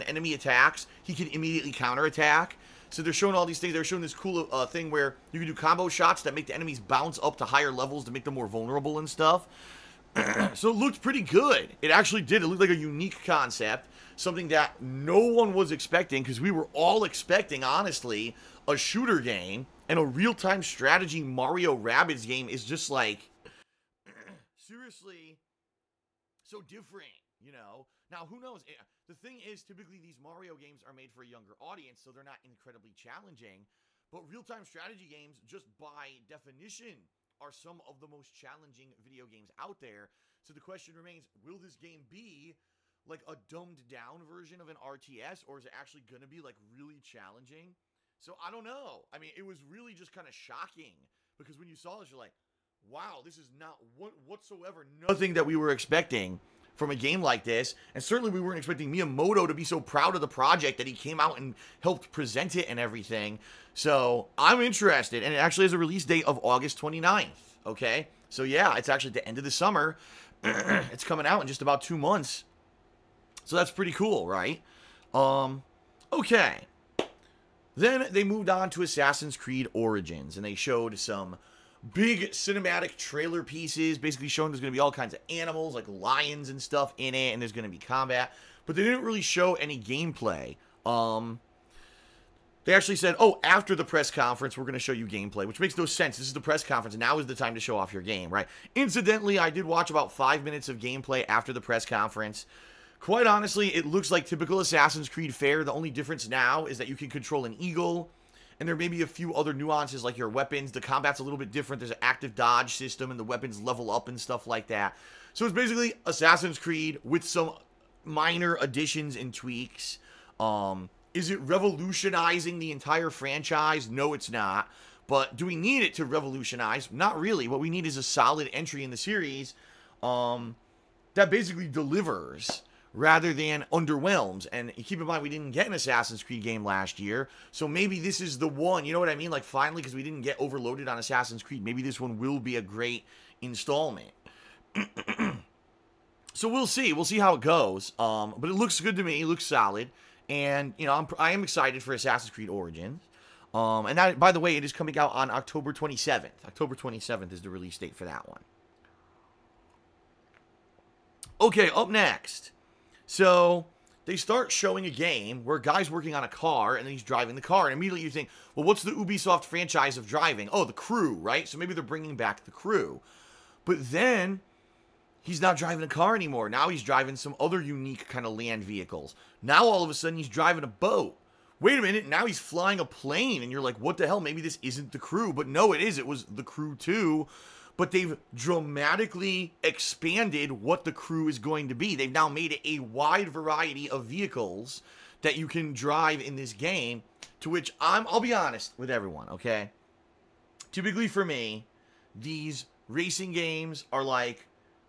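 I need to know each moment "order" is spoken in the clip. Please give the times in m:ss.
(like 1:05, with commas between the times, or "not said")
not said.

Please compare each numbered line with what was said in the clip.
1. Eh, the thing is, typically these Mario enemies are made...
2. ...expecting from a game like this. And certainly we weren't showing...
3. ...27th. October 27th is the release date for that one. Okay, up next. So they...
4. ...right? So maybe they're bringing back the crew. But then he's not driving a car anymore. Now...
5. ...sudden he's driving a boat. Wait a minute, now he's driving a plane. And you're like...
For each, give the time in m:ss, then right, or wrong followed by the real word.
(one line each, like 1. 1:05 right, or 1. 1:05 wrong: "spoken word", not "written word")
1. 0:28 wrong: "games", not "enemies"
2. 0:55 wrong: "expecting", not "showing"
3. 2:35 right
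4. 2:51 right
5. 2:59 wrong: "flying", not "driving".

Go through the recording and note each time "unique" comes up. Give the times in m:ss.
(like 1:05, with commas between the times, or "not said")
0:12, 2:57.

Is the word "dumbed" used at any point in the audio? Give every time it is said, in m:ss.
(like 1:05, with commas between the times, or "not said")
0:43.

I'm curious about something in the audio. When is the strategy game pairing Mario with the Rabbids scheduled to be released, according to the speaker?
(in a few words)
August 29th.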